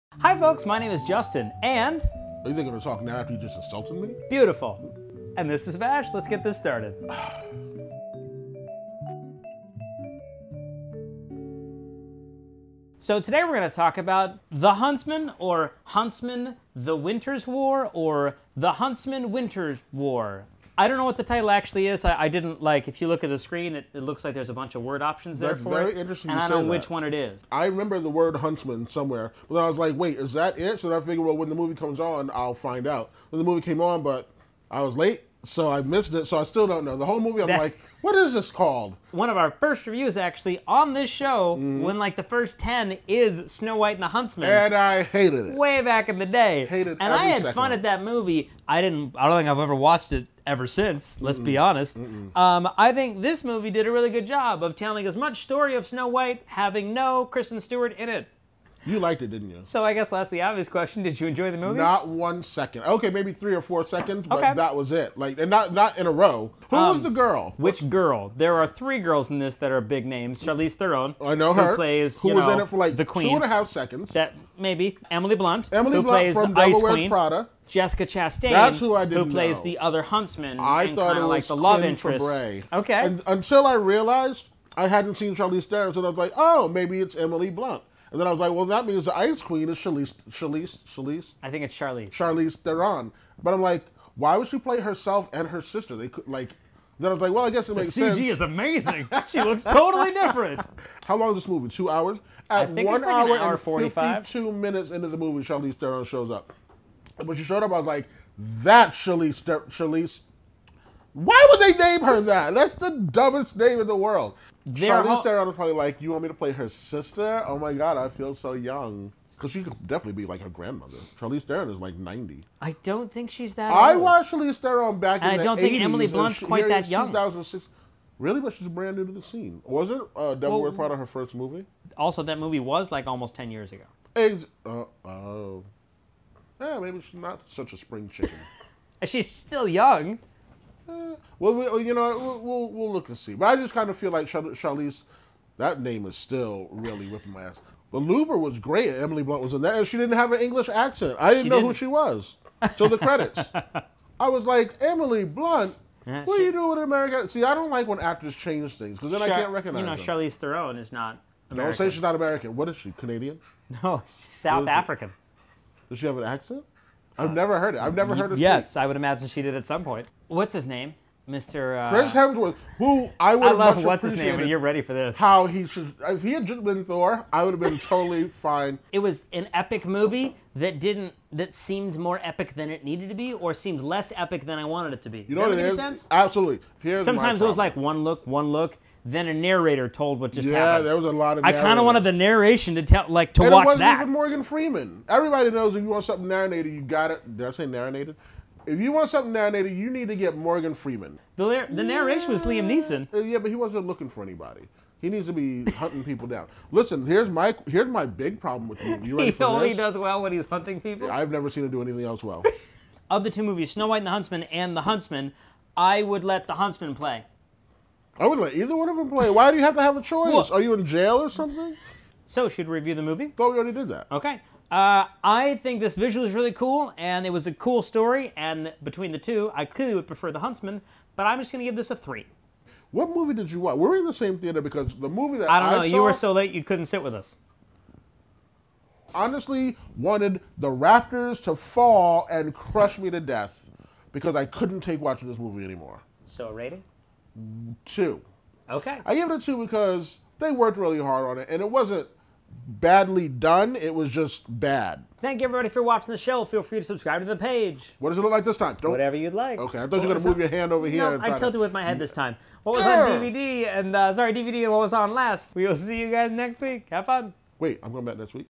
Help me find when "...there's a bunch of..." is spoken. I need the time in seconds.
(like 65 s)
24 s.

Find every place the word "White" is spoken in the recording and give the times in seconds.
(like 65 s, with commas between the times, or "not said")
43 s, 56 s, 213 s.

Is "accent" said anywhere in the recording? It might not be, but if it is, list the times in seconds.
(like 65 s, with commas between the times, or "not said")
150 s, 166 s.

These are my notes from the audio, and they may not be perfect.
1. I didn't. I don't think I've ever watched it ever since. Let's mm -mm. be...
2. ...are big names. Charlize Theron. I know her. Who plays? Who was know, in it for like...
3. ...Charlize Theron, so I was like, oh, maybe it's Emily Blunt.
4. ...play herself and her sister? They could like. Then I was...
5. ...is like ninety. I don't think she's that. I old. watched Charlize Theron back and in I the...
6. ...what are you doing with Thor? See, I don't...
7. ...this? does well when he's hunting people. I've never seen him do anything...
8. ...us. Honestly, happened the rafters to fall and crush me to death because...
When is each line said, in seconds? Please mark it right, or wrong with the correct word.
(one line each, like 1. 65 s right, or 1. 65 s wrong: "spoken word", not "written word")
1. 48 s right
2. 69 s right
3. 85 s right
4. 94 s right
5. 121 s right
6. 156 s wrong: "America", not "Thor"
7. 209 s right
8. 237 s wrong: "wanted", not "happened".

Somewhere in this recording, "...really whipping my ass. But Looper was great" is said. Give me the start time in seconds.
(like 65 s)
146 s.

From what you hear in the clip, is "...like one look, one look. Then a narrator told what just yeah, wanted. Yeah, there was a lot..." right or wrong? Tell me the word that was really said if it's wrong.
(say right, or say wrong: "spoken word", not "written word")
wrong: "happened", not "wanted".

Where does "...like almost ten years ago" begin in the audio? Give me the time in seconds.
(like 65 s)
132 s.